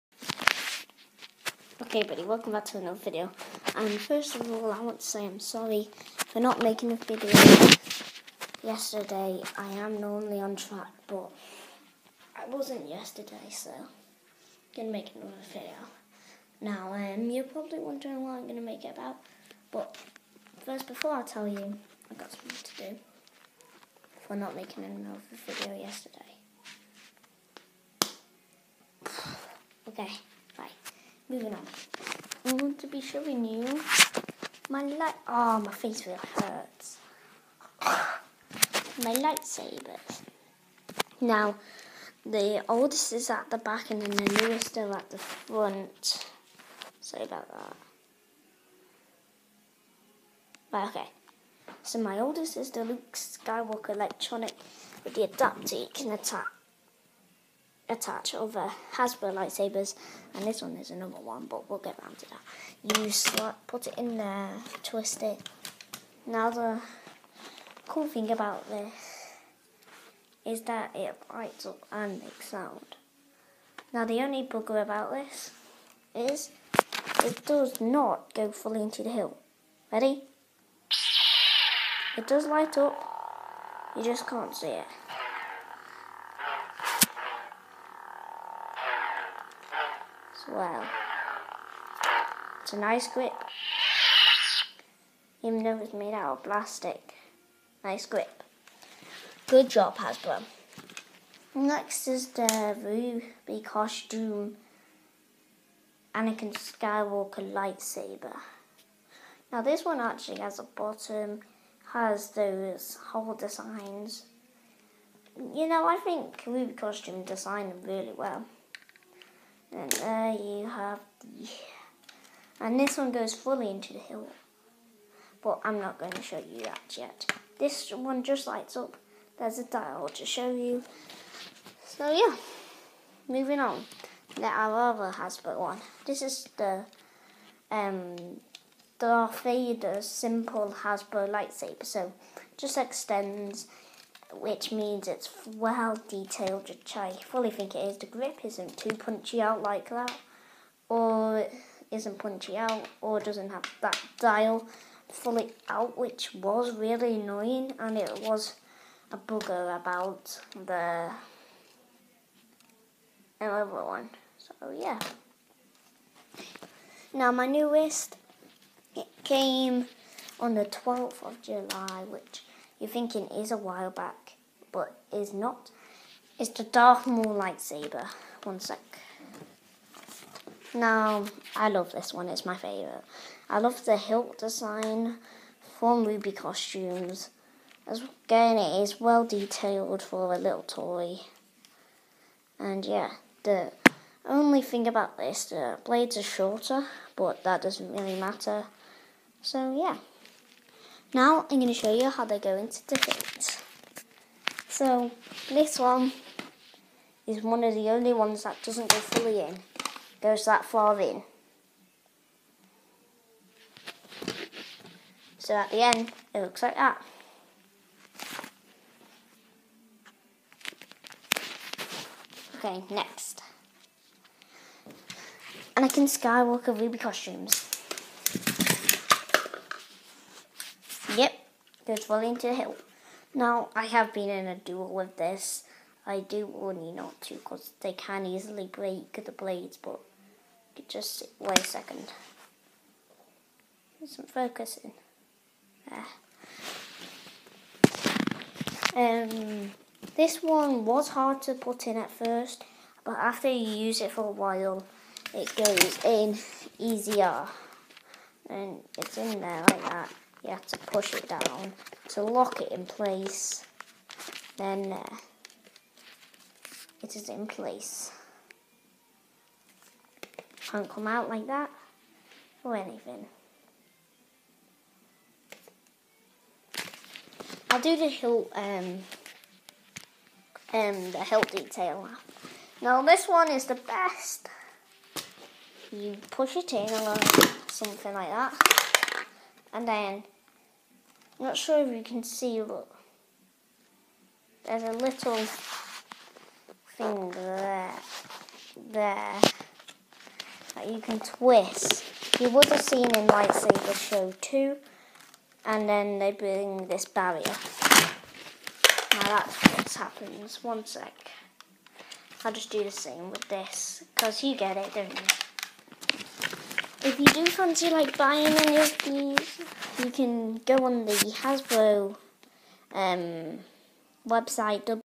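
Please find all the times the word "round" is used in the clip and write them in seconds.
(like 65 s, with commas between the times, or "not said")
62 s.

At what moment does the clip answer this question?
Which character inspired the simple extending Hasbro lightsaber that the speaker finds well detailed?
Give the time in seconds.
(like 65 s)
138 s.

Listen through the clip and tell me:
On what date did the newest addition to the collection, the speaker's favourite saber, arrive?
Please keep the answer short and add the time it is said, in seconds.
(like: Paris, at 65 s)
12th of July, at 170 s.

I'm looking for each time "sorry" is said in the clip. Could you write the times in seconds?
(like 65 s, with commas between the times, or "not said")
5 s, 46 s.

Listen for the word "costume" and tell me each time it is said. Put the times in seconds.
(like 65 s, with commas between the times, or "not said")
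103 s, 116 s, 186 s, 226 s.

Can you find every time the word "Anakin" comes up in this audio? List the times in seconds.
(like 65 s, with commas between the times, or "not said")
106 s, 225 s.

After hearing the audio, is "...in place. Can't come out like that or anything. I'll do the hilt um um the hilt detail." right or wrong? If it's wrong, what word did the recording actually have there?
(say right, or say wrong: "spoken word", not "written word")
right.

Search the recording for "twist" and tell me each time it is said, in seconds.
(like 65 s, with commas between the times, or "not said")
64 s, 301 s.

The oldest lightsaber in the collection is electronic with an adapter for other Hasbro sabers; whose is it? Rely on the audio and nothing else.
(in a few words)
Luke Skywalker.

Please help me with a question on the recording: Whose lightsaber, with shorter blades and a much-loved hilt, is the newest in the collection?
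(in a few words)
Darth Maul.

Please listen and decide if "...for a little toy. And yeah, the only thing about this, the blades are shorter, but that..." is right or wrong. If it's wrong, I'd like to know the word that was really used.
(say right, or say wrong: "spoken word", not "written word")
right.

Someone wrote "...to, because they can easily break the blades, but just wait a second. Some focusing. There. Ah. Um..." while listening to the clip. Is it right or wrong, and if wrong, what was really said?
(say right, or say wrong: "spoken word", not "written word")
right.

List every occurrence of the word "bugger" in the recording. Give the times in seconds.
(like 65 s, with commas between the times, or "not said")
74 s, 159 s.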